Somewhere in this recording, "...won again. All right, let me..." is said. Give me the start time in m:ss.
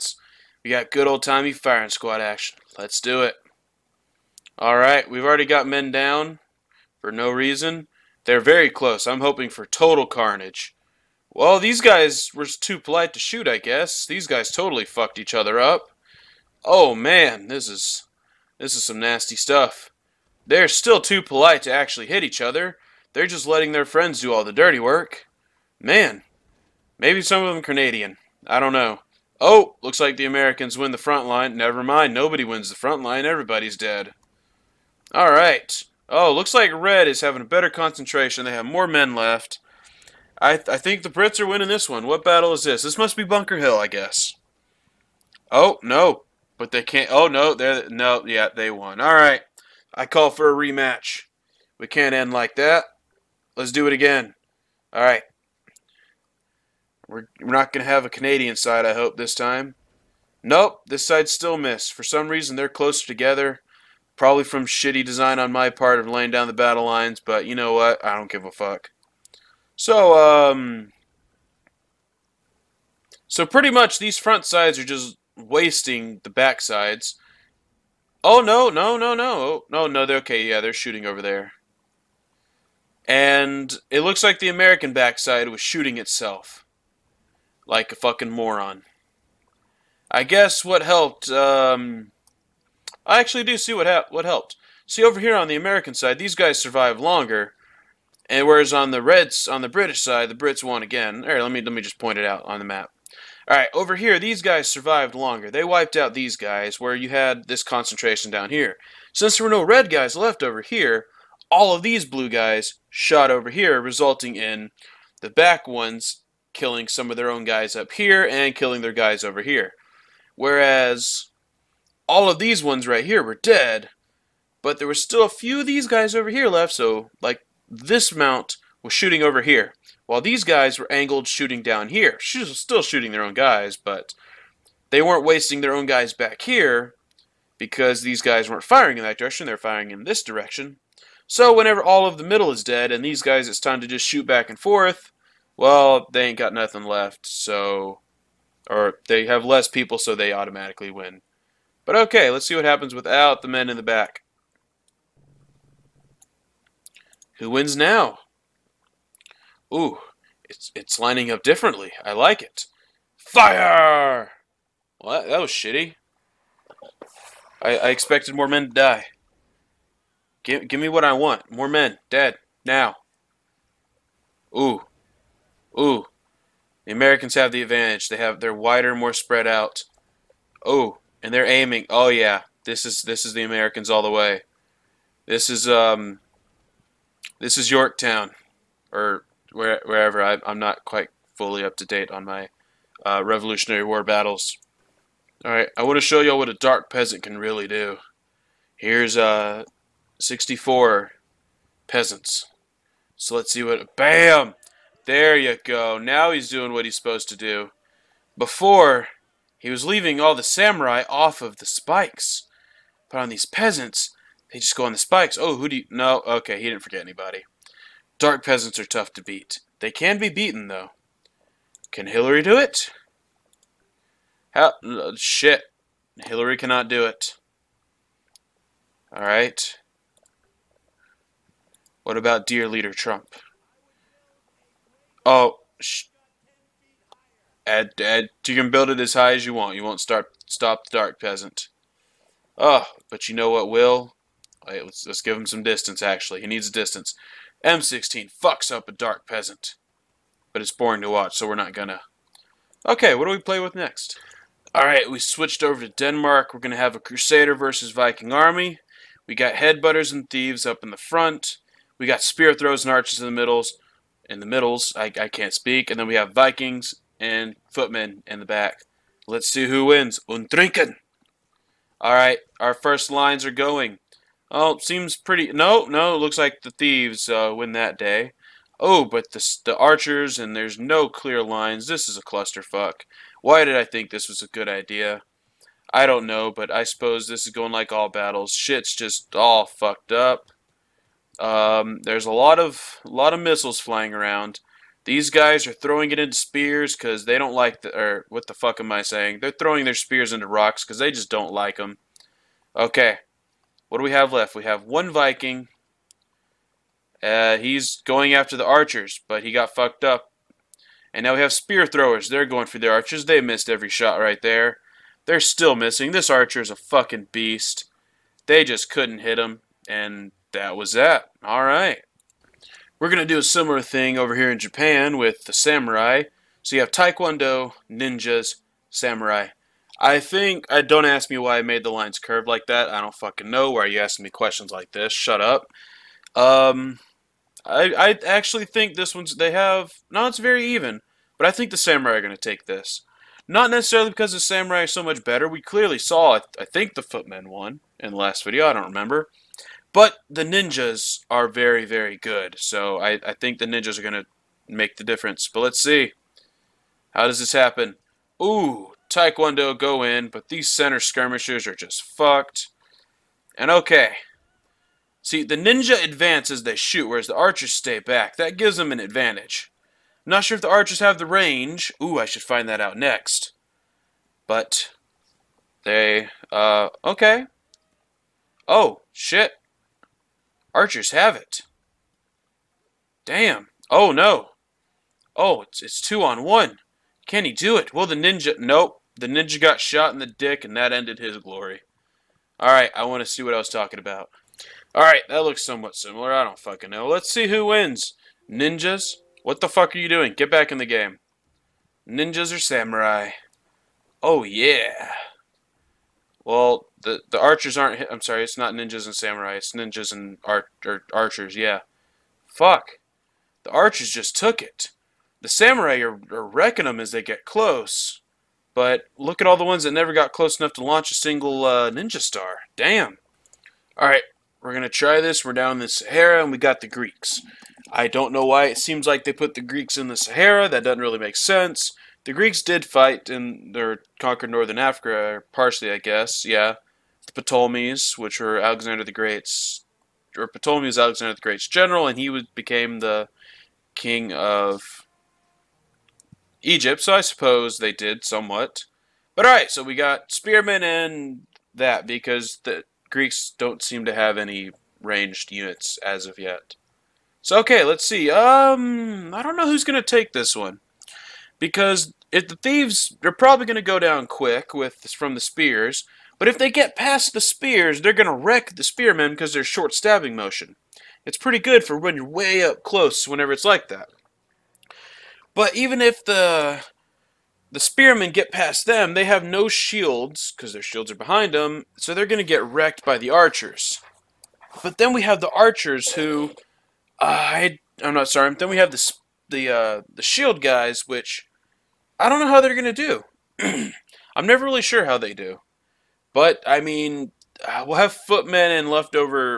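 1:40.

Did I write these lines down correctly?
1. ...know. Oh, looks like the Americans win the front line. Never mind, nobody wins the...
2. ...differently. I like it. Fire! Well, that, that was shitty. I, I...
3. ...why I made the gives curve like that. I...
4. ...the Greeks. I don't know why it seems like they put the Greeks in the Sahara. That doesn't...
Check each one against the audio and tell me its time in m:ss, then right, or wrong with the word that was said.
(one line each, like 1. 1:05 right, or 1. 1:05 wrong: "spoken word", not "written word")
1. 0:28 right
2. 2:41 right
3. 5:31 wrong: "lines", not "gives"
4. 7:06 right.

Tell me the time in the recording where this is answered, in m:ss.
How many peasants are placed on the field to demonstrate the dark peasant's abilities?
3:20.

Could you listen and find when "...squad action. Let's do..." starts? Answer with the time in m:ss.
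0:01.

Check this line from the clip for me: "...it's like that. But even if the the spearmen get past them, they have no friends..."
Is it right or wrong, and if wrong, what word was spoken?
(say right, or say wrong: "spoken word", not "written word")
wrong: "shields", not "friends".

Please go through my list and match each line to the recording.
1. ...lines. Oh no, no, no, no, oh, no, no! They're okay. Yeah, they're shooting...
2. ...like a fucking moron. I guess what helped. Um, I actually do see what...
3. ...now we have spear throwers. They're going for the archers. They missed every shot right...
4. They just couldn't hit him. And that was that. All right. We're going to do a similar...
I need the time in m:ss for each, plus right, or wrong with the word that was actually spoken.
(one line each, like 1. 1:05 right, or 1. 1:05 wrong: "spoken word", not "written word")
1. 1:16 wrong: "sides", not "lines"
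2. 1:27 right
3. 5:11 right
4. 5:18 right.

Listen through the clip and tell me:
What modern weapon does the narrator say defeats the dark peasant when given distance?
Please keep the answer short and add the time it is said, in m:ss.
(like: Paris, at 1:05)
M16, at 4:07.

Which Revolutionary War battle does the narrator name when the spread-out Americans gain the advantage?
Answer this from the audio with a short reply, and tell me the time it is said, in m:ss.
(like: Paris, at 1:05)
Yorktown, at 3:07.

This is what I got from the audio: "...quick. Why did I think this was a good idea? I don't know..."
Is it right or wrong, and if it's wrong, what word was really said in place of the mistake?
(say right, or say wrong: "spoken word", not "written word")
wrong: "clusterfuck", not "quick".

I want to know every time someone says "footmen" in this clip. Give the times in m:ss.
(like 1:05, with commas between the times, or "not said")
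4:27, 5:47, 8:18.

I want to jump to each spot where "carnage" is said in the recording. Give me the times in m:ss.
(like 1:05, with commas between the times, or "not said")
0:10.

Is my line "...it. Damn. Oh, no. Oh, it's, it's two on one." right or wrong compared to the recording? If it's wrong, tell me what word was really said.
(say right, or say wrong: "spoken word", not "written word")
right.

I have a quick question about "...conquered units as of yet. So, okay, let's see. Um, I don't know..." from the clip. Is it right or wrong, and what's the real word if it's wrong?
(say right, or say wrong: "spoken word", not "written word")
wrong: "ranged", not "conquered".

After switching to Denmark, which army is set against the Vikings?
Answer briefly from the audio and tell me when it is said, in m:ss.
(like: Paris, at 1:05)
Crusader, at 4:16.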